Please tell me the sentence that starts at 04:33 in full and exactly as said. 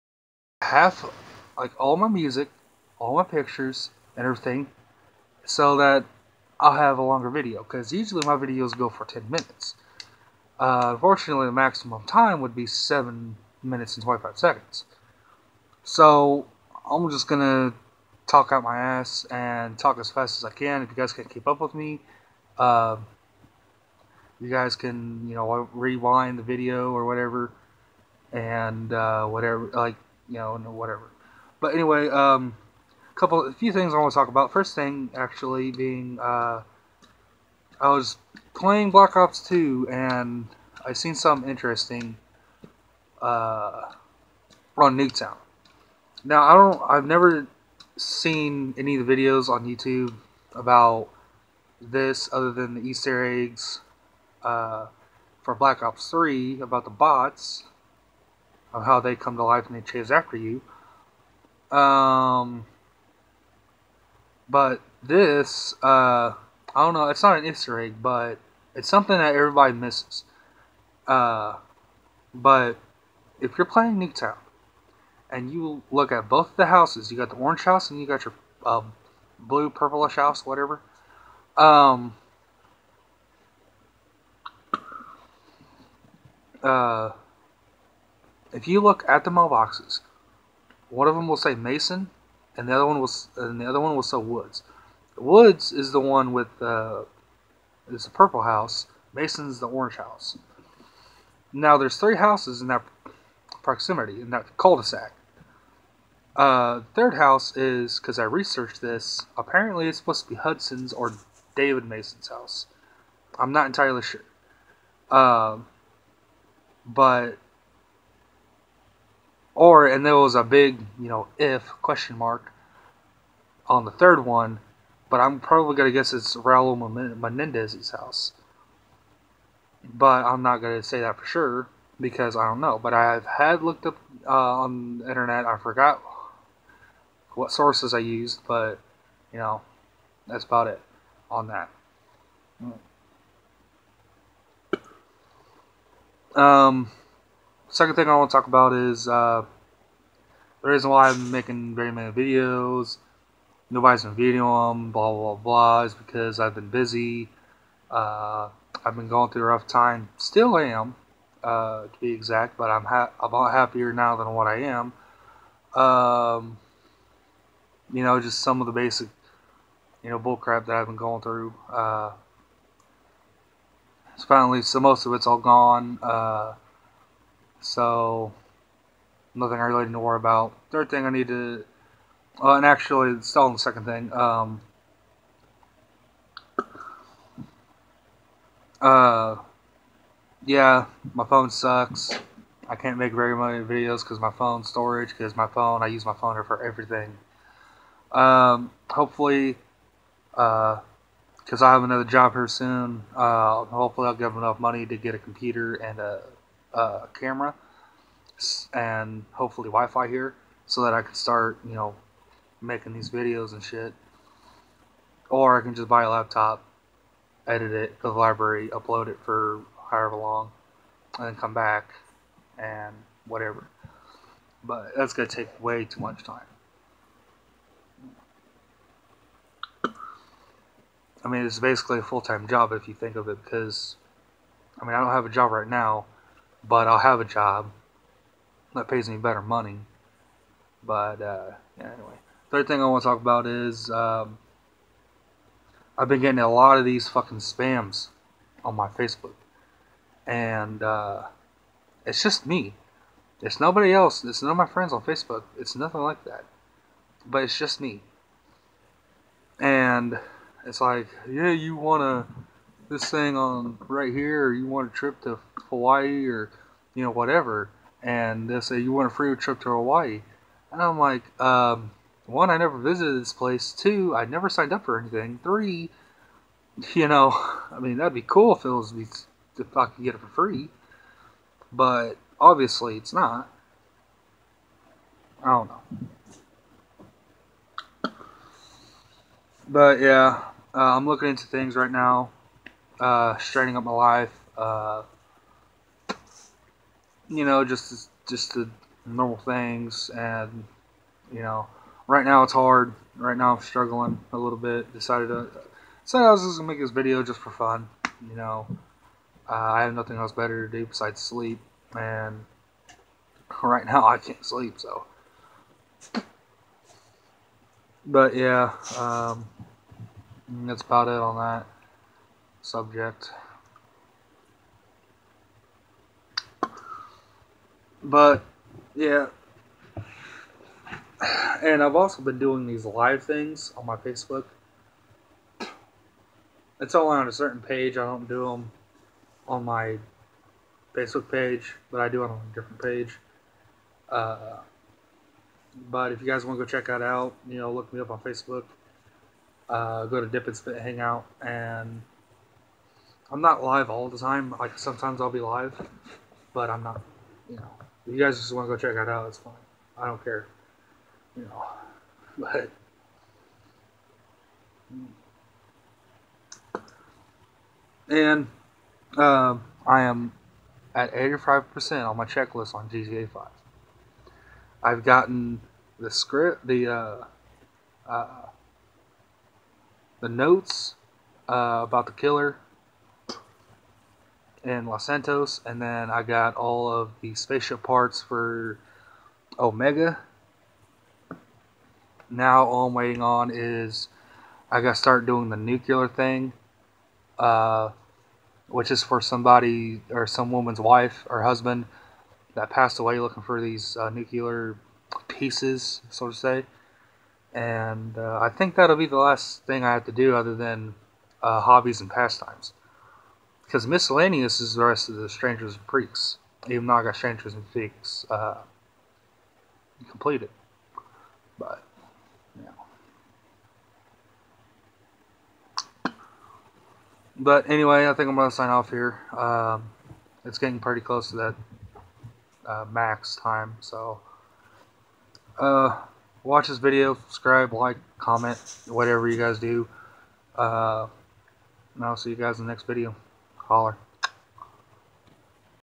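Two, I never signed up for anything.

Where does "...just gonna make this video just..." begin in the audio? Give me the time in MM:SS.
05:06.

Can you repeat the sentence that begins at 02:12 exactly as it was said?
But I've had looked up uh, on the internet.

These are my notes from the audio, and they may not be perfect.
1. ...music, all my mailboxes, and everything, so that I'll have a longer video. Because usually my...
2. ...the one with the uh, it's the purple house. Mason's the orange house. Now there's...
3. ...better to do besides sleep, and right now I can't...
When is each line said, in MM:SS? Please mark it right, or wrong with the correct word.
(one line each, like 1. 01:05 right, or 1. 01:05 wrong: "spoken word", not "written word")
1. 00:02 wrong: "pictures", not "mailboxes"
2. 01:35 right
3. 05:10 right.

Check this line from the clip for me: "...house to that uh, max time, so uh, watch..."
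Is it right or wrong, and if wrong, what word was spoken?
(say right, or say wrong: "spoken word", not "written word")
wrong: "close", not "house".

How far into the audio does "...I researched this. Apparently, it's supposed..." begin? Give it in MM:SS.
01:48.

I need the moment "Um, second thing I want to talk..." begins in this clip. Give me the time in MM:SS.
02:26.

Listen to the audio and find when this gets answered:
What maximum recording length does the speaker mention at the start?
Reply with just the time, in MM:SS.
00:12.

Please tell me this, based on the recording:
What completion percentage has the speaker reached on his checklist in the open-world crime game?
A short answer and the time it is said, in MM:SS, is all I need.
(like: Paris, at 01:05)
85%, at 06:11.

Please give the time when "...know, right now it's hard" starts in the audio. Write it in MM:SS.
05:01.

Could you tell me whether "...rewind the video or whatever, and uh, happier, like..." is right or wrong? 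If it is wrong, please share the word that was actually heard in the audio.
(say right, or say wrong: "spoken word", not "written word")
wrong: "whatever", not "happier".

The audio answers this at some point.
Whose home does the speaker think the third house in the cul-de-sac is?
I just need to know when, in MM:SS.
02:06.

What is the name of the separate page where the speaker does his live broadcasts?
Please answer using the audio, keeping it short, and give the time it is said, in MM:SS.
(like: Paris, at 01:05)
Dip and Spit Hangout, at 05:50.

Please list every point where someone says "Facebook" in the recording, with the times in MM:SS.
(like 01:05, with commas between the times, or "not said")
04:08, 04:15, 05:33, 05:40, 05:48.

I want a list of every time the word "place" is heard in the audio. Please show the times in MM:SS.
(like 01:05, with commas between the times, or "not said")
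04:33.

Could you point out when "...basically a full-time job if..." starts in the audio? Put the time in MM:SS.
03:51.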